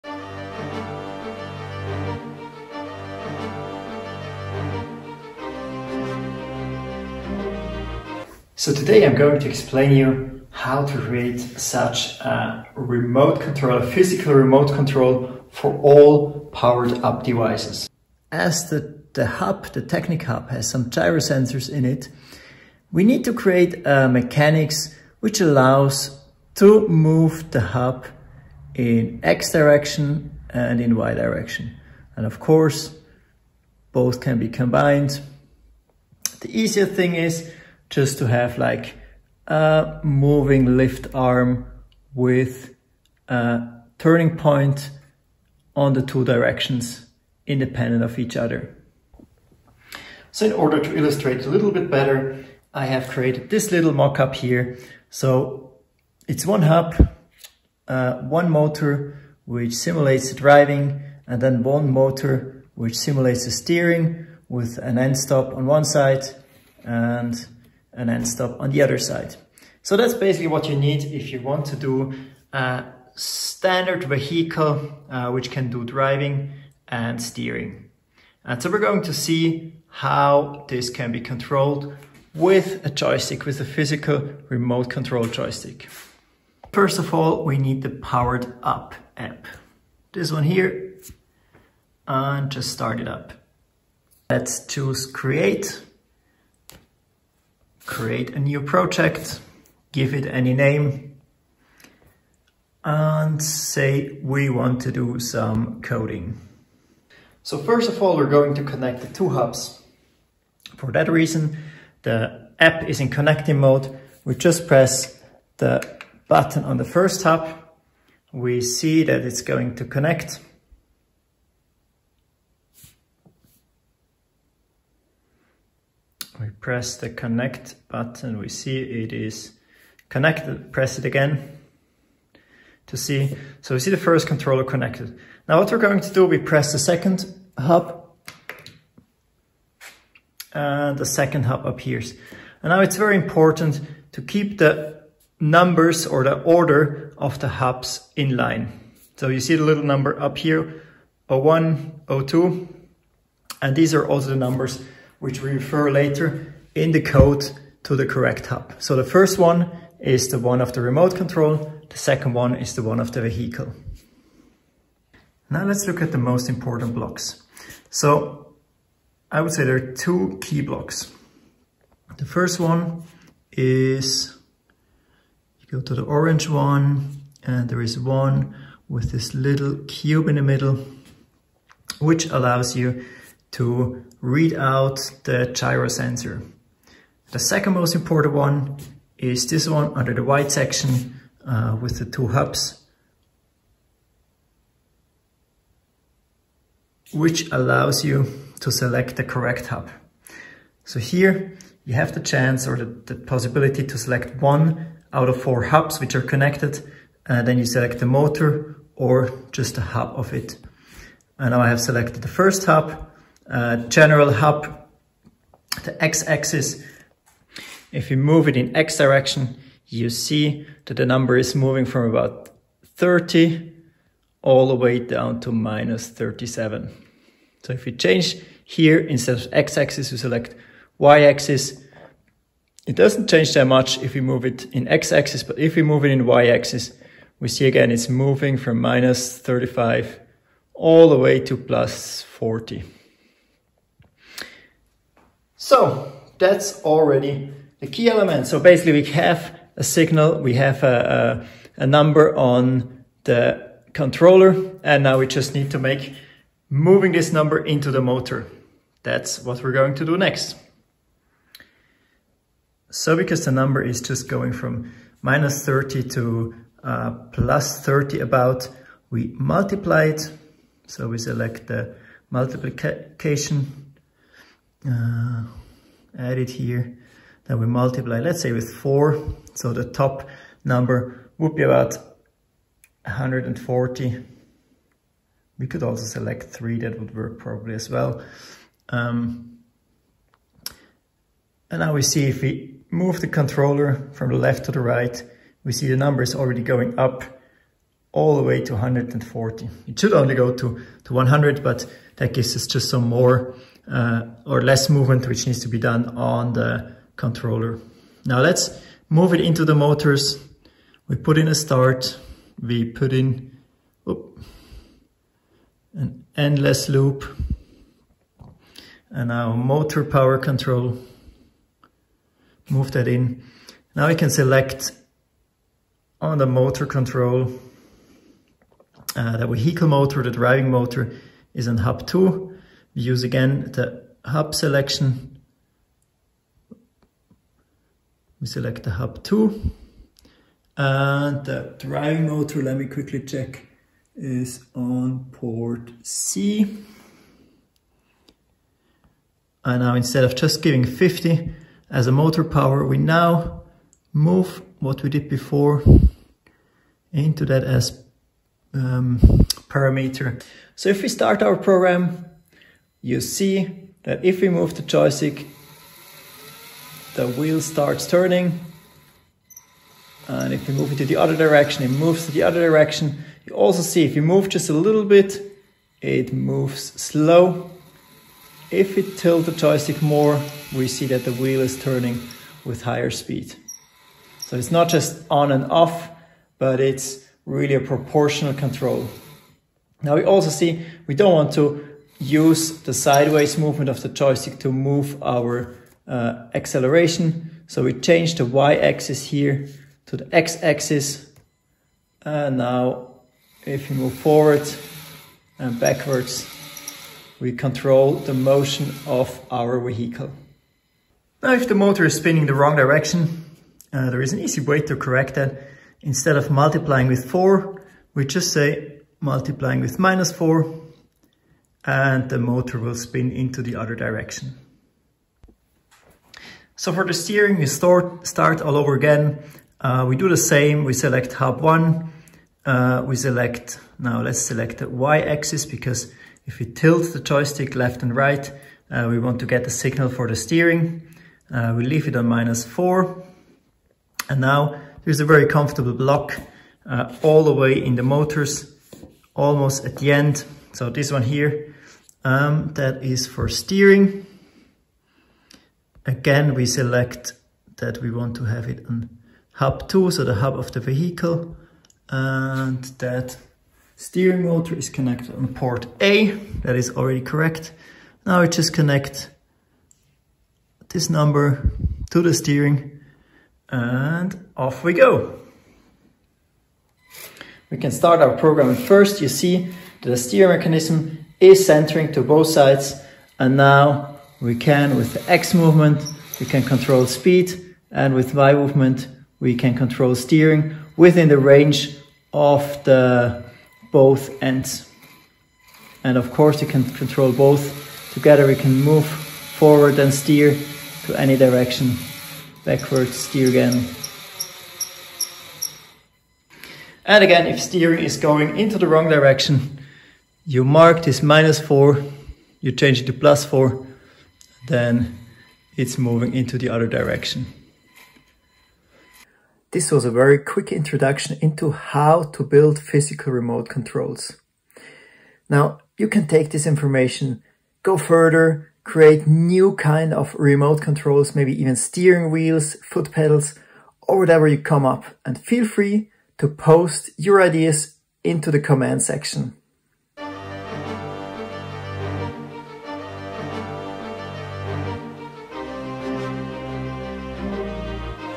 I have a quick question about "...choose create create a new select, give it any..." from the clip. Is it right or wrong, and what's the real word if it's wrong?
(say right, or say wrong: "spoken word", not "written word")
wrong: "project", not "select".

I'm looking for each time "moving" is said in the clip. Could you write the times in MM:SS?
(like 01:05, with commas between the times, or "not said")
00:40, 03:41, 03:58, 04:16, 08:35.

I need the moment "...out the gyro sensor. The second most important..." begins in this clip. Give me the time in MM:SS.
03:04.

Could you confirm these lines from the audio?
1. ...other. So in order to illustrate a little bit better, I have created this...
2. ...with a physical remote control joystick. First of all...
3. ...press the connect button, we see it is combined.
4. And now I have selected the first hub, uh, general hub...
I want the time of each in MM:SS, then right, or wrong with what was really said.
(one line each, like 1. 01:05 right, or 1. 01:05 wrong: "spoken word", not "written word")
1. 00:48 right
2. 01:23 right
3. 02:06 wrong: "connected", not "combined"
4. 03:31 right.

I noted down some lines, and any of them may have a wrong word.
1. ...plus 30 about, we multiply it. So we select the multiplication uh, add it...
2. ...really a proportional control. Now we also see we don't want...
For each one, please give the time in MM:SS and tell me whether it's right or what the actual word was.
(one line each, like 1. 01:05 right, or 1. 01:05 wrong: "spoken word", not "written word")
1. 04:27 right
2. 06:27 right.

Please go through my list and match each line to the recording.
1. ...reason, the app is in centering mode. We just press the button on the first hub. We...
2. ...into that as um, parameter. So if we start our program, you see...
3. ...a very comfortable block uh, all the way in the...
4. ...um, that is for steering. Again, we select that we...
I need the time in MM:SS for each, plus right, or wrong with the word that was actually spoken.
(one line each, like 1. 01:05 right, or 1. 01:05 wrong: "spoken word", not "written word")
1. 01:51 wrong: "connecting", not "centering"
2. 05:57 right
3. 07:25 right
4. 07:32 right.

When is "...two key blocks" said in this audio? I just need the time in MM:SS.
02:50.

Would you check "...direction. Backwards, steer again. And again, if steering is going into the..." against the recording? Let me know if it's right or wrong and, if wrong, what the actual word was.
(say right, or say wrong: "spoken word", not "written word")
right.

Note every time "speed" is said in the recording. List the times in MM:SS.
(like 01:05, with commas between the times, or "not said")
06:23, 08:07.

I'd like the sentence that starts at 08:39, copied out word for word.
This was a very quick introduction into how to build physical remote controls.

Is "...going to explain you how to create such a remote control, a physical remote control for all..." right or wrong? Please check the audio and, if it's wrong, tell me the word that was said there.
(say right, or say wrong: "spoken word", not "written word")
right.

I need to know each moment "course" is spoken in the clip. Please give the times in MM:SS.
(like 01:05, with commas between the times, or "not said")
00:32, 08:16.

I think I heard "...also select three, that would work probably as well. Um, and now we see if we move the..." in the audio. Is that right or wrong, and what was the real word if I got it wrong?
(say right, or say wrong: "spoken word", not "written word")
right.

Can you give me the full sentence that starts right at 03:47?
So if you change here, instead of x-axis, you select y-axis.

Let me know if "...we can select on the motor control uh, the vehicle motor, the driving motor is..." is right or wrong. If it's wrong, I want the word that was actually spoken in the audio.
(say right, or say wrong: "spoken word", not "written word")
right.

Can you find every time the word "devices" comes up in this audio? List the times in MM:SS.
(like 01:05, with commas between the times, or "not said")
00:17.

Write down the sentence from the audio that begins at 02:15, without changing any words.
Now what we're going to do, we press the second hub and the second hub appears.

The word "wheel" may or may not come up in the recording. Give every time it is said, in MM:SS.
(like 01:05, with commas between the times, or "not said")
06:07, 06:21, 08:52.